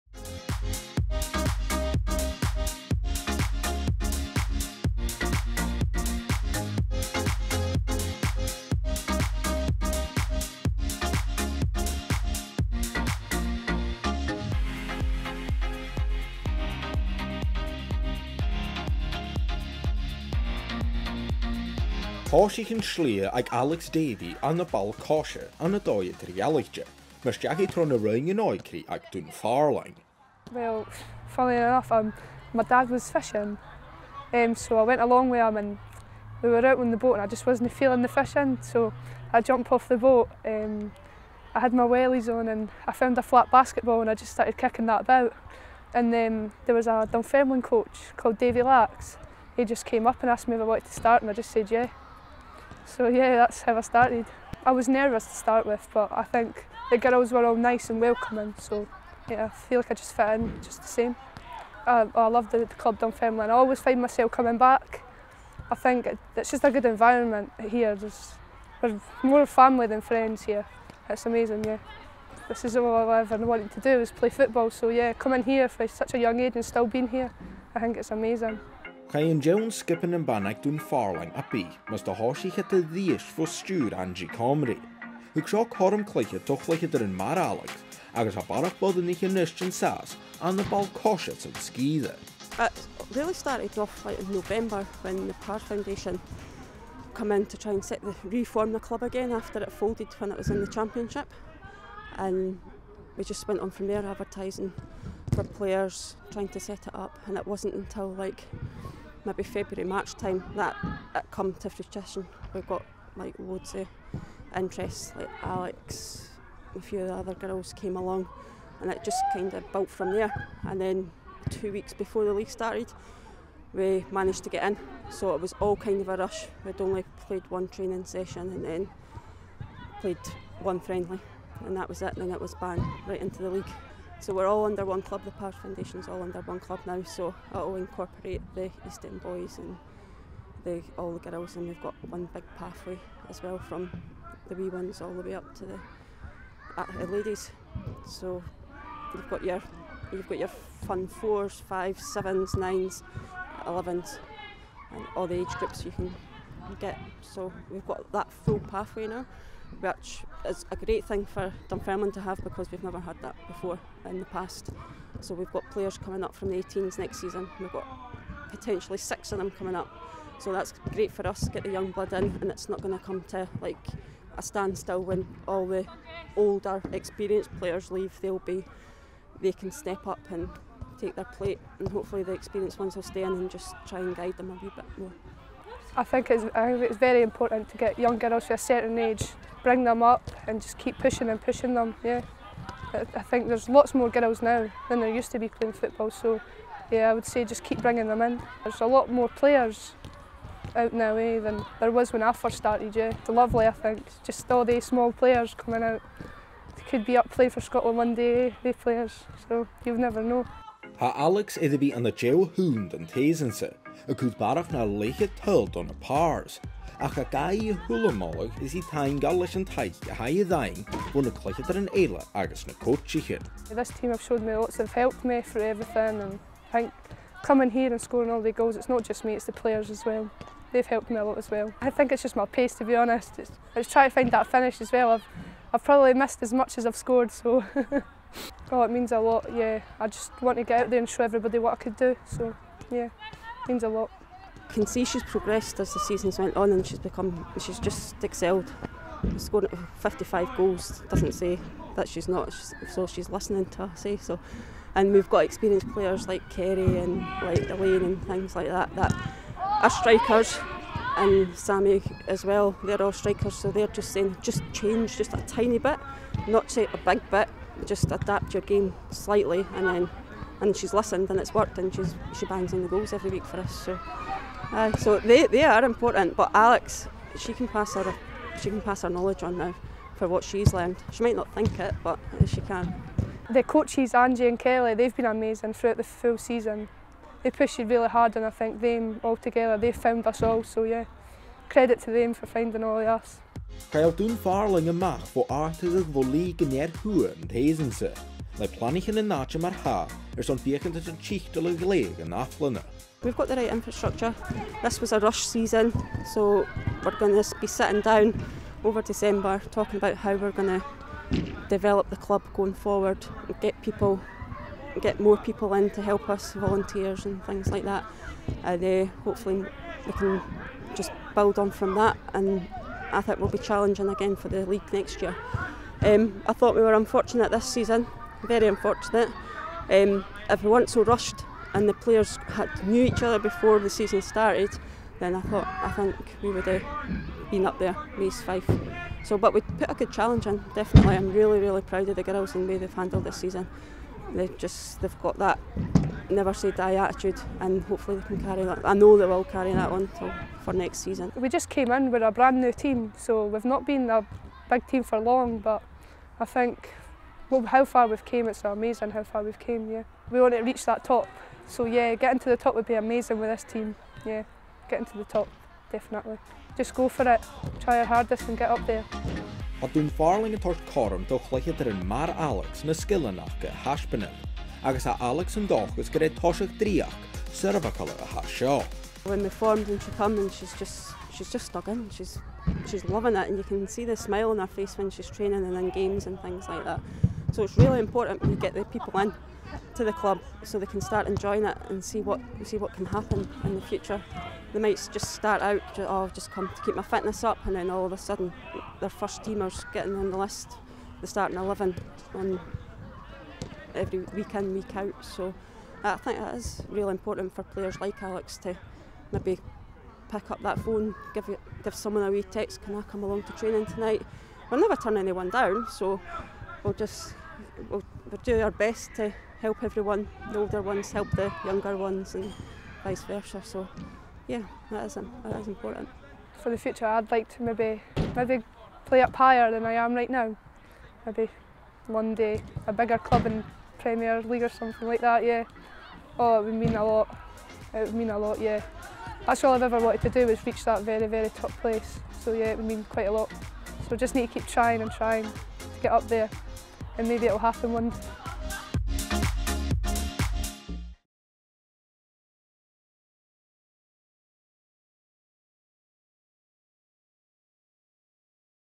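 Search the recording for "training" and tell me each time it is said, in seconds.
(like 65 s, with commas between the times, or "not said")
127 s, 385 s, 413 s.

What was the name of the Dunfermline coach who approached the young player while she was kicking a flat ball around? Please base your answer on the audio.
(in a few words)
Davy Lax.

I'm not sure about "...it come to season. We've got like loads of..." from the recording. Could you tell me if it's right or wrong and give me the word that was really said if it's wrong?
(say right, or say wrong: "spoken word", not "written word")
wrong: "fruition", not "season".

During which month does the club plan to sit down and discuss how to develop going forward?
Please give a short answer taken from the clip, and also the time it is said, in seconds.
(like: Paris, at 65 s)
December, at 309 s.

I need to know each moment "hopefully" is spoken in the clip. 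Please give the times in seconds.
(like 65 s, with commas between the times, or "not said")
181 s, 319 s, 347 s.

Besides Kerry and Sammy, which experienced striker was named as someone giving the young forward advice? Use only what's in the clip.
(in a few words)
Elaine.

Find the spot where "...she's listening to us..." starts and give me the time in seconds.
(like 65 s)
253 s.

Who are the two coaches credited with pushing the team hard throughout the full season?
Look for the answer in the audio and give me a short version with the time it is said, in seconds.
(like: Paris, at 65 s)
Angie and Kelly, at 284 s.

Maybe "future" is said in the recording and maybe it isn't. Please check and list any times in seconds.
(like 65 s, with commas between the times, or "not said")
393 s, 426 s.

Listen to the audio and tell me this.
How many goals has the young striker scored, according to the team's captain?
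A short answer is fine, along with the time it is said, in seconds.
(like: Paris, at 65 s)
55, at 249 s.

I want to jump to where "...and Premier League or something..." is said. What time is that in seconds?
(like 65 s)
433 s.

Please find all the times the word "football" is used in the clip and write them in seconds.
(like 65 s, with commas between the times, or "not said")
74 s, 195 s.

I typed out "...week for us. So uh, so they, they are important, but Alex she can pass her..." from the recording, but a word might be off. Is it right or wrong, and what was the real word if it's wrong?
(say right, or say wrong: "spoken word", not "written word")
right.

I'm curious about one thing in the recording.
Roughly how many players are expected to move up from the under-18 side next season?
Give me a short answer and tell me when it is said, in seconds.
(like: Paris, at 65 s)
6, at 168 s.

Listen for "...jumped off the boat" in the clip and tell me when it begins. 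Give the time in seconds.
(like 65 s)
39 s.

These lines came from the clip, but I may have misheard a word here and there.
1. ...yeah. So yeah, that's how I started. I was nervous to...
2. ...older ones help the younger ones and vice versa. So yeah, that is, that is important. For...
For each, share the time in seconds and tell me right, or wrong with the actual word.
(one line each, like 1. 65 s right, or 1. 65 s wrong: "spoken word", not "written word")
1. 51 s right
2. 420 s right.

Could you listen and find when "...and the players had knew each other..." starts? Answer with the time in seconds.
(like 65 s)
331 s.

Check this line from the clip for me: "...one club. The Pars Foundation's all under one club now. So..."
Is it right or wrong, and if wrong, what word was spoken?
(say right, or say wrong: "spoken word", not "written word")
right.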